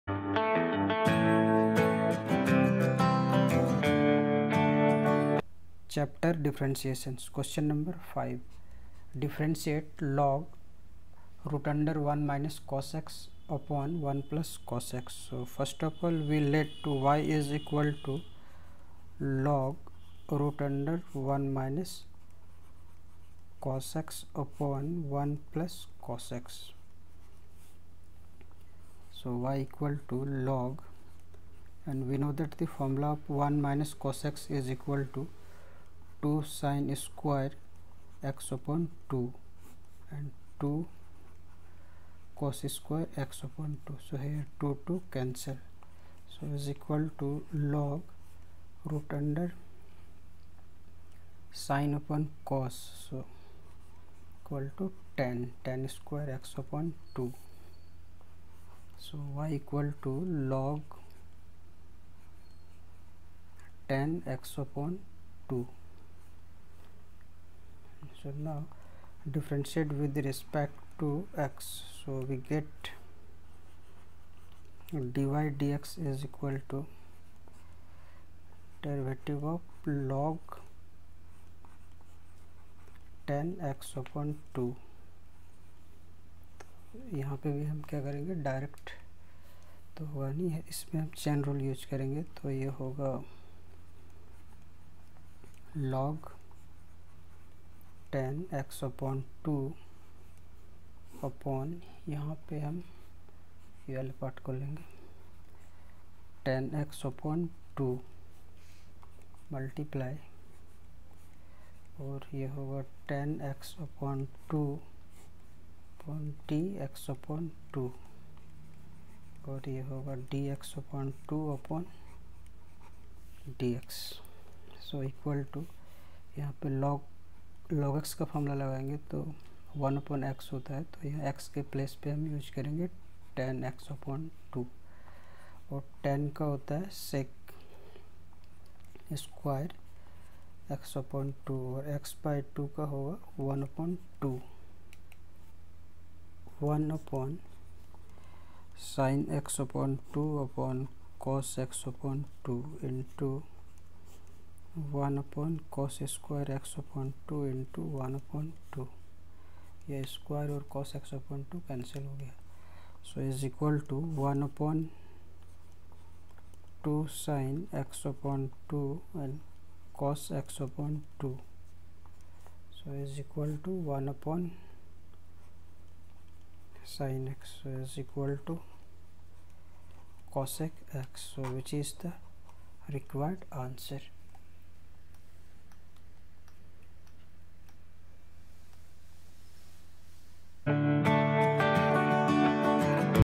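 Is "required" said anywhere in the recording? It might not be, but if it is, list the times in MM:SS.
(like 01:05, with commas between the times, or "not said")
03:02.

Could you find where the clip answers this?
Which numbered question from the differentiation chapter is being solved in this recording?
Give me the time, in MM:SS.
00:07.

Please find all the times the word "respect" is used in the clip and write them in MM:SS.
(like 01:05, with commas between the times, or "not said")
01:10.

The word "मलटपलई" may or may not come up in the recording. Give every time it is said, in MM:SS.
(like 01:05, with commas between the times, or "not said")
01:49.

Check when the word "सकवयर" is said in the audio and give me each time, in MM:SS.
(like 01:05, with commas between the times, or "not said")
02:19, 02:40.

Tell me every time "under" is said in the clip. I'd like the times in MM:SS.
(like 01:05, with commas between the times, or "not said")
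00:11, 00:20, 00:49.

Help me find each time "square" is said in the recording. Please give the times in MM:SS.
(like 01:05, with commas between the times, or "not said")
00:37, 00:42, 00:55, 02:36.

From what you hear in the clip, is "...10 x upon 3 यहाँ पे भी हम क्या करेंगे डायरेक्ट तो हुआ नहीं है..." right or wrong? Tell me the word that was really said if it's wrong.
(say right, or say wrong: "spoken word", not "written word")
wrong: "2", not "3".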